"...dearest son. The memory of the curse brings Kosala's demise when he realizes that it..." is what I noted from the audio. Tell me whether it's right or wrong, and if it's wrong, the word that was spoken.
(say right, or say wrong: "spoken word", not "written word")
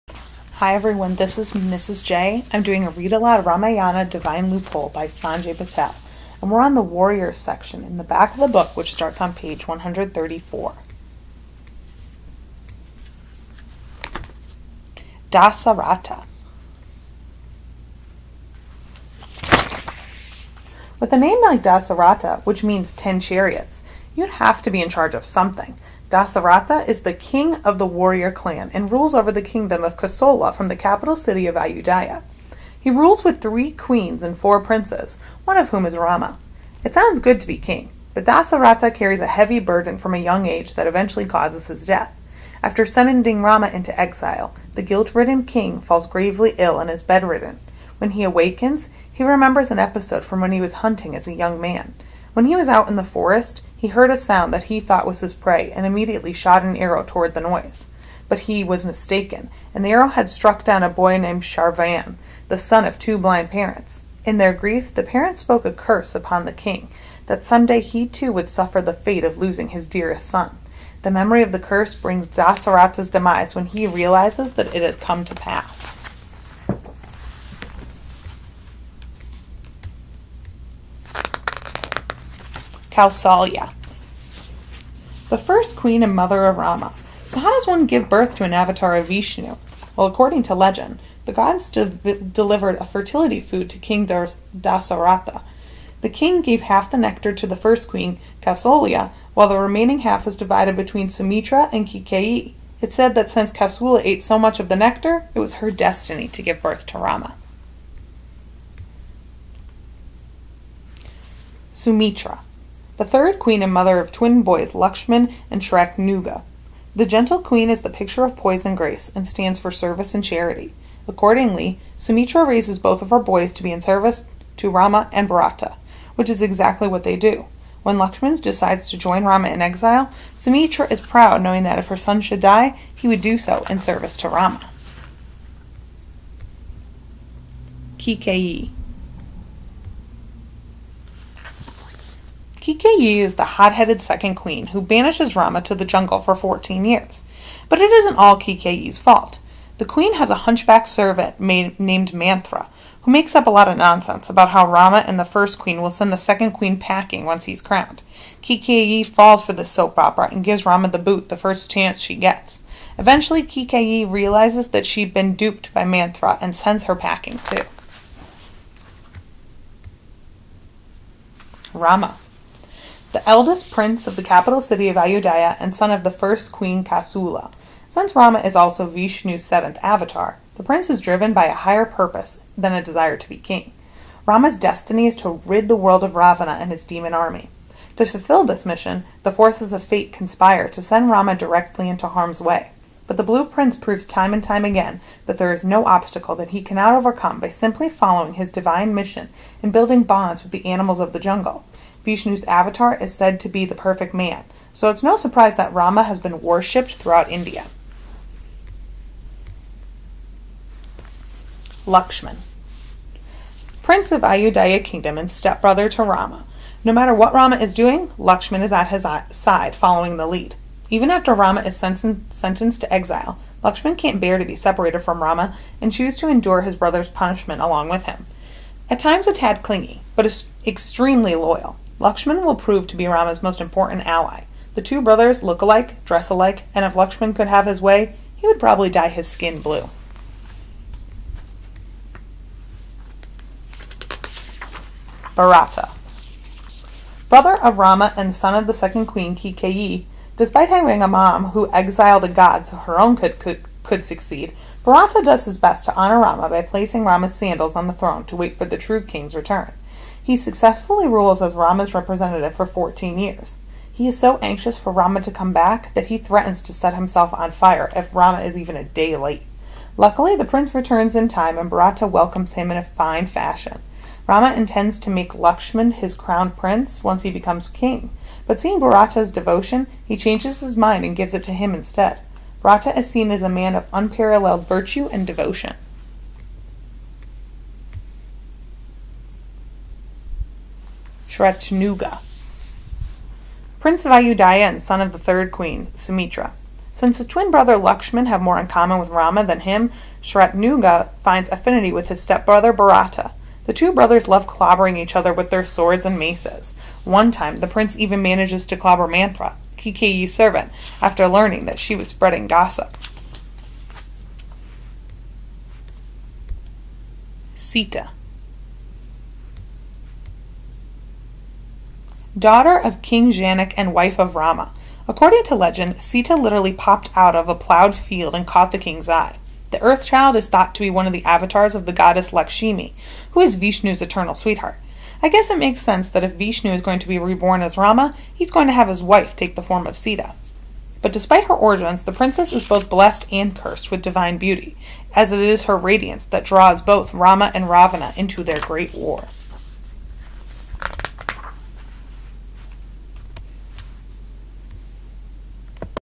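wrong: "Dasaratha", not "Kosala".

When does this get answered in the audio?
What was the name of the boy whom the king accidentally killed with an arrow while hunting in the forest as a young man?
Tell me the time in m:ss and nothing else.
1:01.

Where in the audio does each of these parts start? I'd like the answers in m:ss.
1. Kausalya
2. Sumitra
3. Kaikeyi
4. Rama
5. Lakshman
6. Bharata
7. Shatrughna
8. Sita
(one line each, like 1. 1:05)
1. 1:21
2. 1:49
3. 2:16
4. 2:50
5. 3:31
6. 4:04
7. 4:50
8. 5:16.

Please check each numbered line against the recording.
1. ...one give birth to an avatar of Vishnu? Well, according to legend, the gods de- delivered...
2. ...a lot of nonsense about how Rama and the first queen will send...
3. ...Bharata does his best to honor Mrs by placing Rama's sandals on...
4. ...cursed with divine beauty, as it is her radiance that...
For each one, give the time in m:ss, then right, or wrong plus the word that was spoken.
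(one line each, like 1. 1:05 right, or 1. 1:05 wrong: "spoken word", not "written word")
1. 1:27 right
2. 2:33 right
3. 4:14 wrong: "Rama", not "Mrs"
4. 5:43 right.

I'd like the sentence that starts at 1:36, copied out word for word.
The king gave half the nectar to the first queen, Kausalya, while the remaining half was divided between Sumitra and Kaikeyi.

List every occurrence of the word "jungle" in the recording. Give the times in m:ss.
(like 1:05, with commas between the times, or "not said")
2:25, 3:21.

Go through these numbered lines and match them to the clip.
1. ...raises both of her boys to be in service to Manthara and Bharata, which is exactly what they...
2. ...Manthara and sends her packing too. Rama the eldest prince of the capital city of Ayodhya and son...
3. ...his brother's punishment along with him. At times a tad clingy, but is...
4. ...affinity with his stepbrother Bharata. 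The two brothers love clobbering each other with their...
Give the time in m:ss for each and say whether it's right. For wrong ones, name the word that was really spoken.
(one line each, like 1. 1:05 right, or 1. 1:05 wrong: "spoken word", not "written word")
1. 2:02 wrong: "Rama", not "Manthara"
2. 2:45 right
3. 3:46 right
4. 5:01 right.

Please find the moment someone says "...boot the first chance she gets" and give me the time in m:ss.
2:40.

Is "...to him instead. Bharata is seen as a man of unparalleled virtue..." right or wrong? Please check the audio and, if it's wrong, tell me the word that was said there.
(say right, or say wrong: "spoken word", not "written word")
right.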